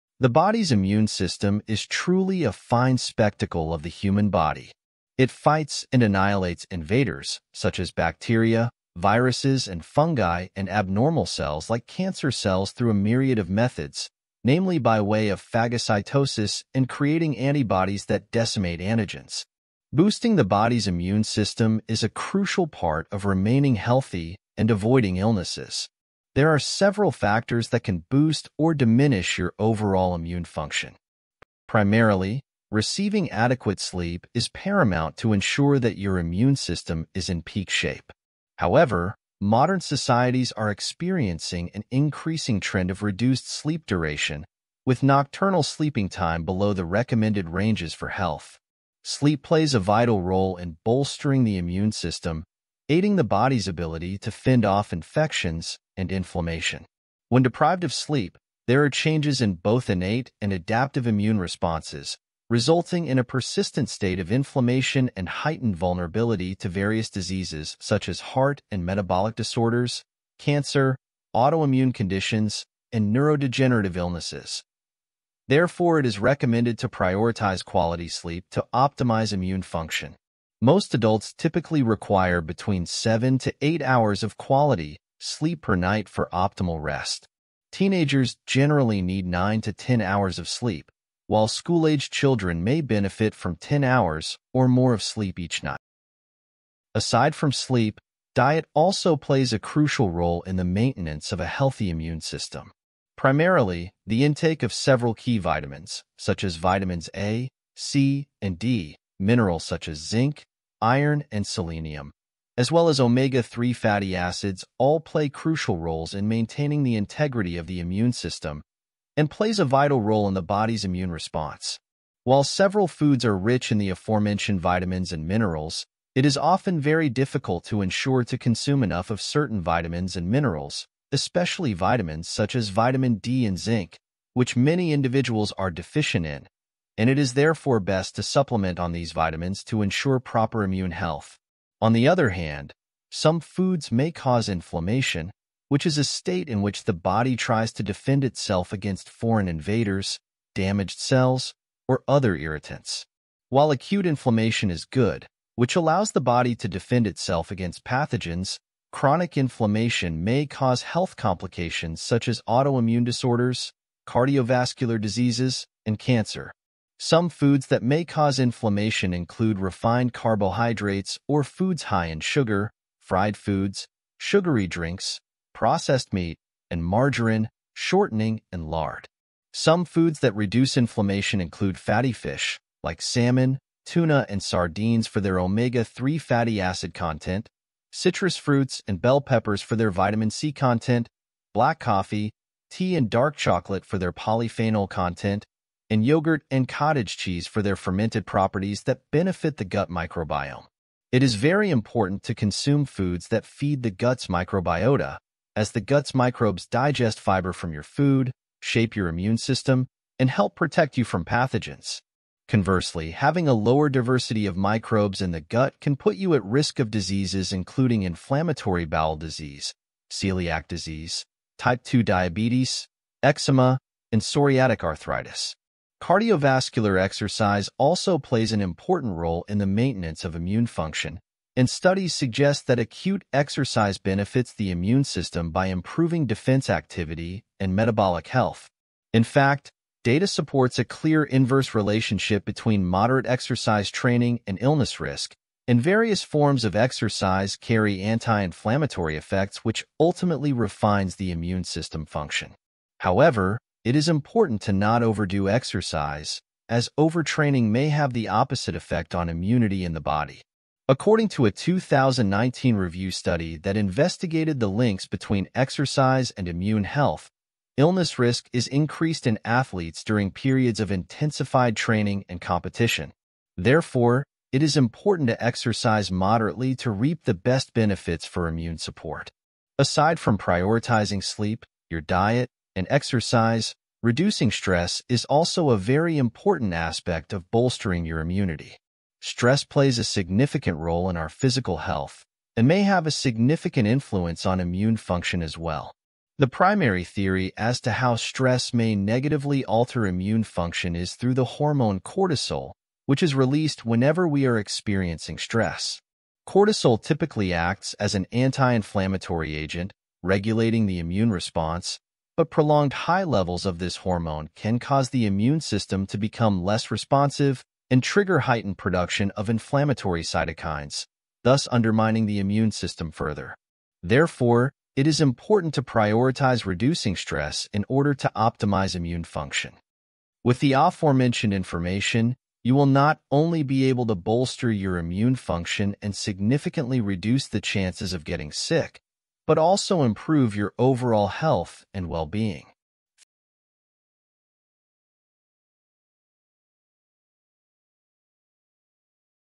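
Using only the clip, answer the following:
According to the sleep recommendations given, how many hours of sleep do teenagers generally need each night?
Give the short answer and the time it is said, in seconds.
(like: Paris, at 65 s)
9 to 10 hours, at 89 s.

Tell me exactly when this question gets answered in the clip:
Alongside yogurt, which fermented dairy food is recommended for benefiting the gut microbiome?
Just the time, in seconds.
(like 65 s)
196 s.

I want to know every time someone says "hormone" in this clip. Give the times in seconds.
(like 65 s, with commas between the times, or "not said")
301 s, 313 s.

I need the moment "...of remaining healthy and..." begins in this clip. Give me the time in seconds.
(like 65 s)
23 s.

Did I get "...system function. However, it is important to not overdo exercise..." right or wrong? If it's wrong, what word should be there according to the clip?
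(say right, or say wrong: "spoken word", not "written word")
right.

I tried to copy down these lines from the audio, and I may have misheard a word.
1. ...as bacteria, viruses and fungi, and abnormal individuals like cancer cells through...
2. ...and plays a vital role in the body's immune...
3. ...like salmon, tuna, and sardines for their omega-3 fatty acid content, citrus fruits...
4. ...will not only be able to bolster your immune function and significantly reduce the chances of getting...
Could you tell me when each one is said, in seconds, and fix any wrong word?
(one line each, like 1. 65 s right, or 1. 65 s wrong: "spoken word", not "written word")
1. 7 s wrong: "cells", not "individuals"
2. 119 s right
3. 182 s right
4. 332 s right.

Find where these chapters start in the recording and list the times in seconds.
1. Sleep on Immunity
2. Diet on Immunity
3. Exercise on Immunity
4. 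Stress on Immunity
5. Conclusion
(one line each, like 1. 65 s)
1. 31 s
2. 96 s
3. 226 s
4. 279 s
5. 330 s.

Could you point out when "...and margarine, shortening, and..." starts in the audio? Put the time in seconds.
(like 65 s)
176 s.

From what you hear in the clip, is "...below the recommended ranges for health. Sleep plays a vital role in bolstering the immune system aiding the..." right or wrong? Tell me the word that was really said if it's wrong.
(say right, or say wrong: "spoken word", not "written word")
right.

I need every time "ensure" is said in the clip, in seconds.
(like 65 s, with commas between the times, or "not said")
35 s, 127 s, 139 s.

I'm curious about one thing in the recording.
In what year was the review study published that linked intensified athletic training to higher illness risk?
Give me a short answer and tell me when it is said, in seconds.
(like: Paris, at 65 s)
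2019, at 261 s.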